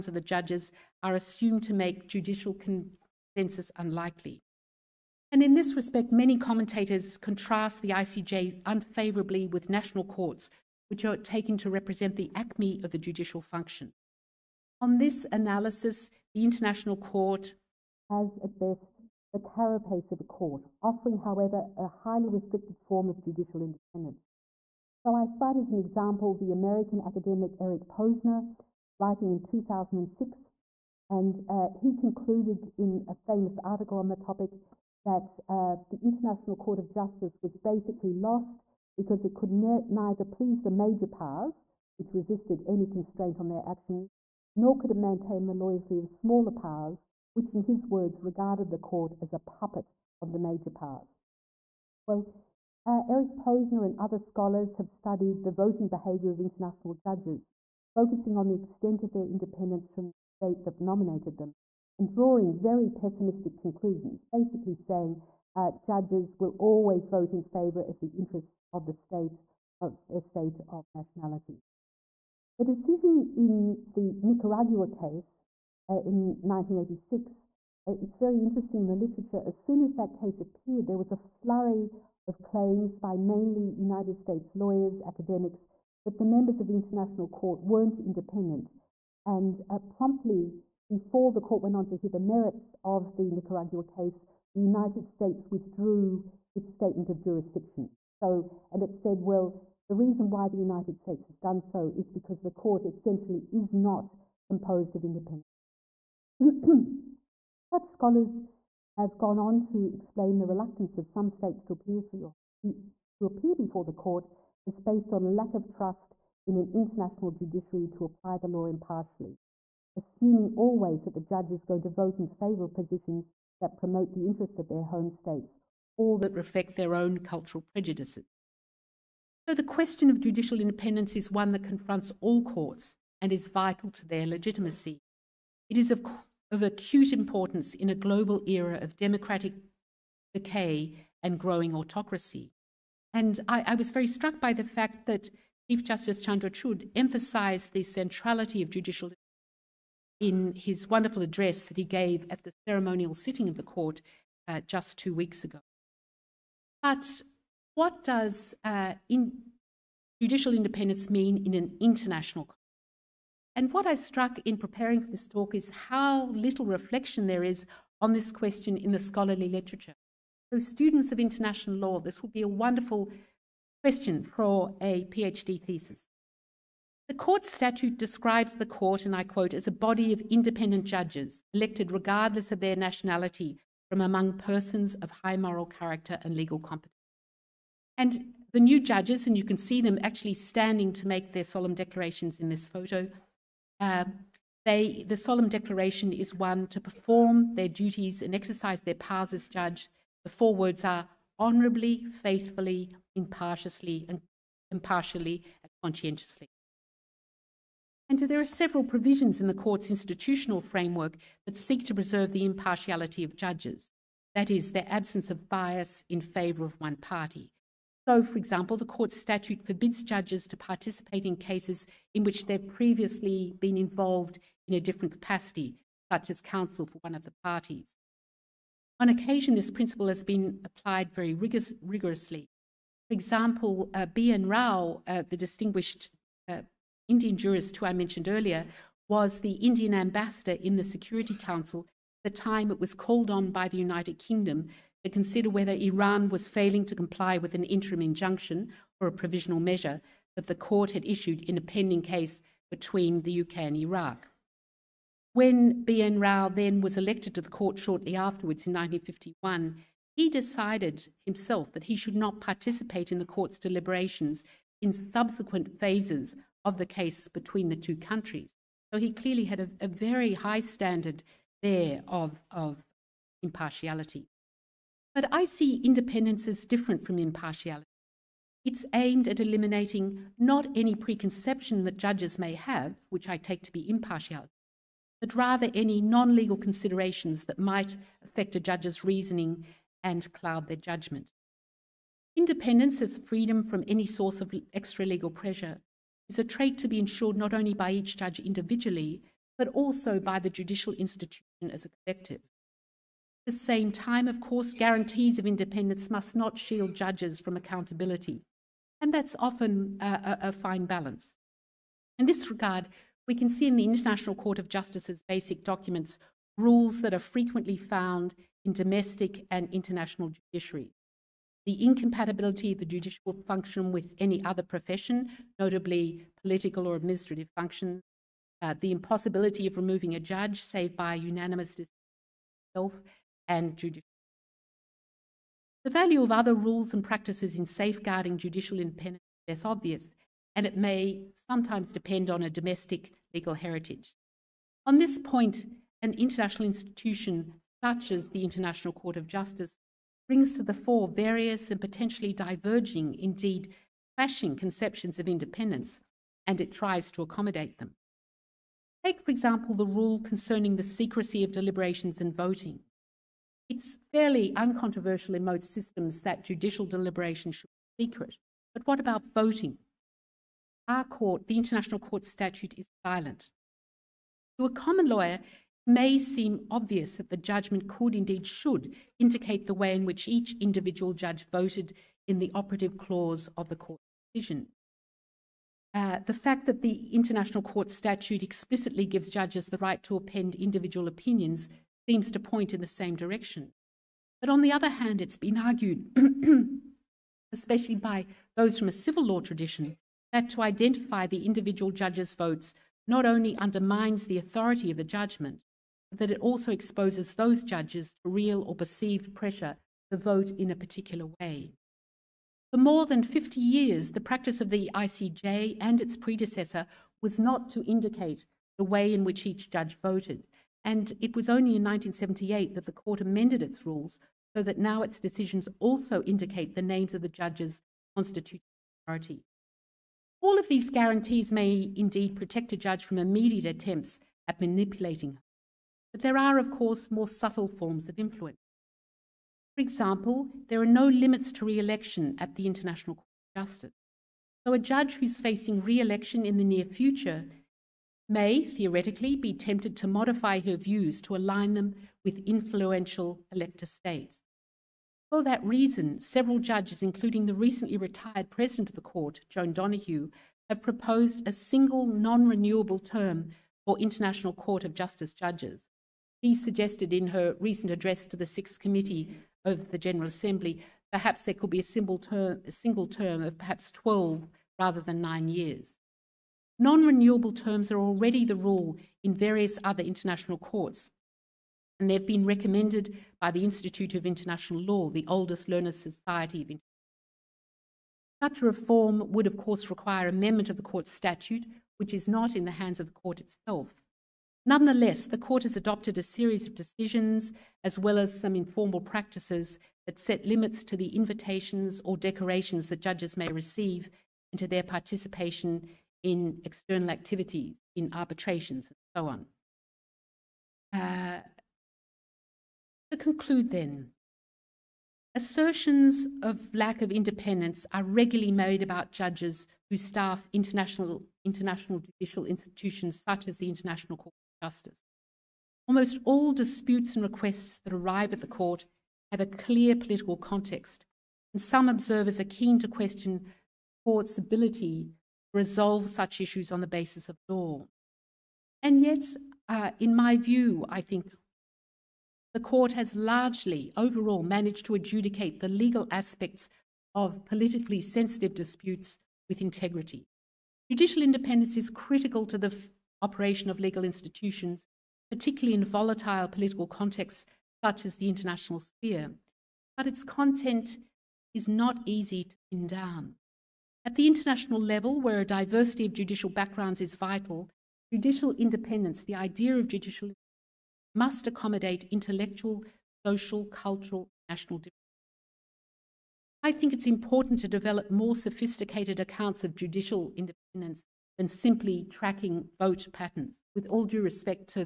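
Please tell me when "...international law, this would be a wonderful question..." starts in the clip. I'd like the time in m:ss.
2:51.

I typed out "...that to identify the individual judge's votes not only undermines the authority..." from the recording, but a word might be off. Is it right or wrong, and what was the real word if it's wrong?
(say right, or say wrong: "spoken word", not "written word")
right.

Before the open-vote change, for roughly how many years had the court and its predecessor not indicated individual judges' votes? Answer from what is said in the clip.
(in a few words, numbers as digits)
More than 50.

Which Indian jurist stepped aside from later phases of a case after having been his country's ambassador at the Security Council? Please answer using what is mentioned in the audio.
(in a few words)
B. N. Rau.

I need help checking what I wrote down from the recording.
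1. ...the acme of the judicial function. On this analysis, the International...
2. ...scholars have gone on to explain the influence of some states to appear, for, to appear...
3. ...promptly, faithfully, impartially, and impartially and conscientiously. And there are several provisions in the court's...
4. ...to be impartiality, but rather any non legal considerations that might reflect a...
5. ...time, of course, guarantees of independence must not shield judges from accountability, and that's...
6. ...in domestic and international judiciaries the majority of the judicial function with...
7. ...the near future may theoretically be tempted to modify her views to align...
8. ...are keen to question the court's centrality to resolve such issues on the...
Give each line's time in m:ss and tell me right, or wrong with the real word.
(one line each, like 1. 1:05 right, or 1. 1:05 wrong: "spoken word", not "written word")
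1. 0:12 right
2. 1:47 wrong: "reluctance", not "influence"
3. 3:21 wrong: "honorably", not "promptly"
4. 4:43 wrong: "affect", not "reflect"
5. 5:03 right
6. 5:18 wrong: "incompatibility", not "majority"
7. 7:26 right
8. 8:52 wrong: "ability", not "centrality".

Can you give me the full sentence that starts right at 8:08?
Such reform would, of course, require amendment of the court's statute, which is not in the hands of the court itself.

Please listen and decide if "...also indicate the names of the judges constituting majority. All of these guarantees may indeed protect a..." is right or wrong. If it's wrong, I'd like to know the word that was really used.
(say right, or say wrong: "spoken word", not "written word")
right.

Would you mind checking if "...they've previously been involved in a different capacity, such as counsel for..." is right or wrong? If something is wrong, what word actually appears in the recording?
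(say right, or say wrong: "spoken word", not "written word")
right.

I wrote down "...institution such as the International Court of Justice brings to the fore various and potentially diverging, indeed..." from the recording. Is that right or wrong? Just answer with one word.
right.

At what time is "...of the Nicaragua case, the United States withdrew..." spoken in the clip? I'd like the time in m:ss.
1:32.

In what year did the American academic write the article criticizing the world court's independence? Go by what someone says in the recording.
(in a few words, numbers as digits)
2006.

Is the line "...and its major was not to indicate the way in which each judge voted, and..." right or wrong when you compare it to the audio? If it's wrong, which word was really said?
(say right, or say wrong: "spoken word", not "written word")
wrong: "predecessor", not "major".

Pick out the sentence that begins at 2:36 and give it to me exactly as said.
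But what does uh, in judicial independence mean in an international context?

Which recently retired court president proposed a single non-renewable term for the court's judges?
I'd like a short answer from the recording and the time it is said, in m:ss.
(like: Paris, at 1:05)
Joan Donoghue, at 7:39.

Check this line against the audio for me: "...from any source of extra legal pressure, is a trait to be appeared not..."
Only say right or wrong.
wrong.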